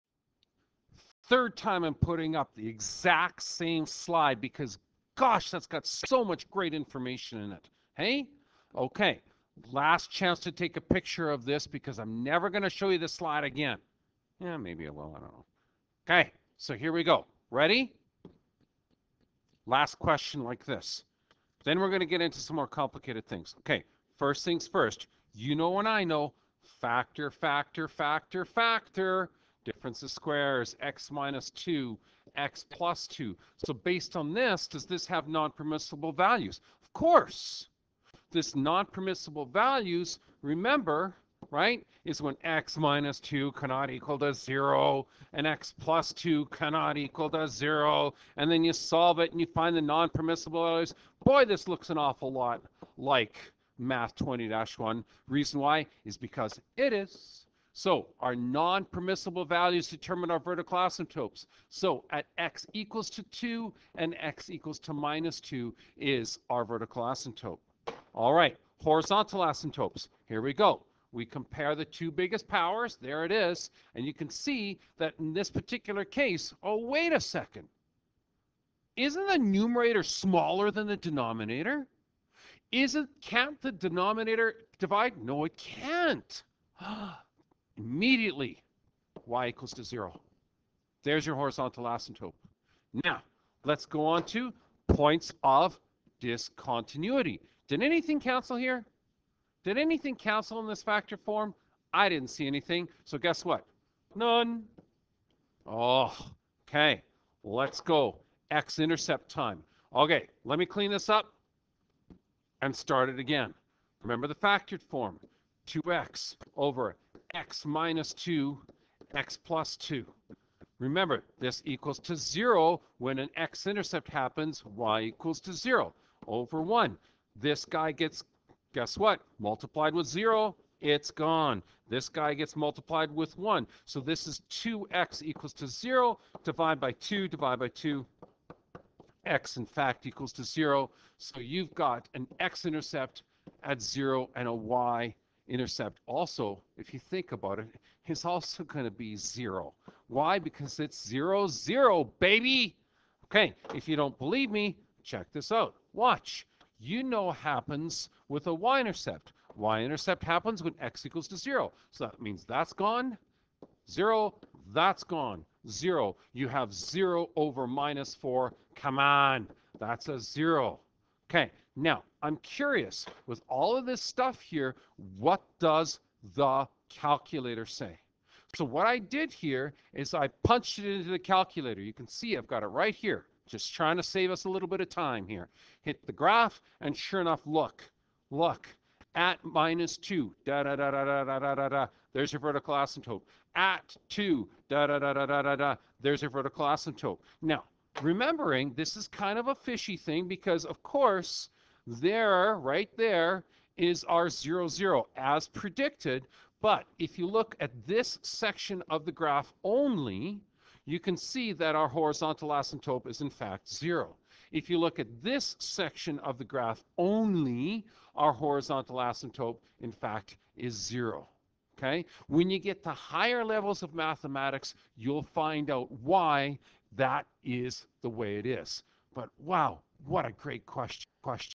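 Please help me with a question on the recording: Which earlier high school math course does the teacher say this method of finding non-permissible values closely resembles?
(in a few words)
Math 20-1.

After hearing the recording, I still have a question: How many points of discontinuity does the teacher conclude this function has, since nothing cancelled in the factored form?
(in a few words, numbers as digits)
None.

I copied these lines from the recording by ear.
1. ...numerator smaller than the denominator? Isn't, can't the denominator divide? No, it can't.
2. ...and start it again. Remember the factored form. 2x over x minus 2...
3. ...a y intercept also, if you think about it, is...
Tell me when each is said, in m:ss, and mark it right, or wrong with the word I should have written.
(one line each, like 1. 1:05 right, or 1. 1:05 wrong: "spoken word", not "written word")
1. 1:19 right
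2. 1:52 right
3. 2:24 right.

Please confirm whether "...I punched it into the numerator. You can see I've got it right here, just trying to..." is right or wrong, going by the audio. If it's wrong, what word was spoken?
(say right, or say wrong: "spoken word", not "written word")
wrong: "calculator", not "numerator".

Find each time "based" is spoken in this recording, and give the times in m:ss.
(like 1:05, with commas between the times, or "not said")
0:33.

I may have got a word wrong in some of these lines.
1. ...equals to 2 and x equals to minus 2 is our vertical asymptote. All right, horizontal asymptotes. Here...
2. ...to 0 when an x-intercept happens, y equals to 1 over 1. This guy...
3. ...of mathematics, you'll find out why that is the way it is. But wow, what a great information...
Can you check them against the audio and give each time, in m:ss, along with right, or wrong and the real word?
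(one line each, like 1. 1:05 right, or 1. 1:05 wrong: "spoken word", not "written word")
1. 1:02 right
2. 2:01 wrong: "0", not "1"
3. 3:43 wrong: "question", not "information".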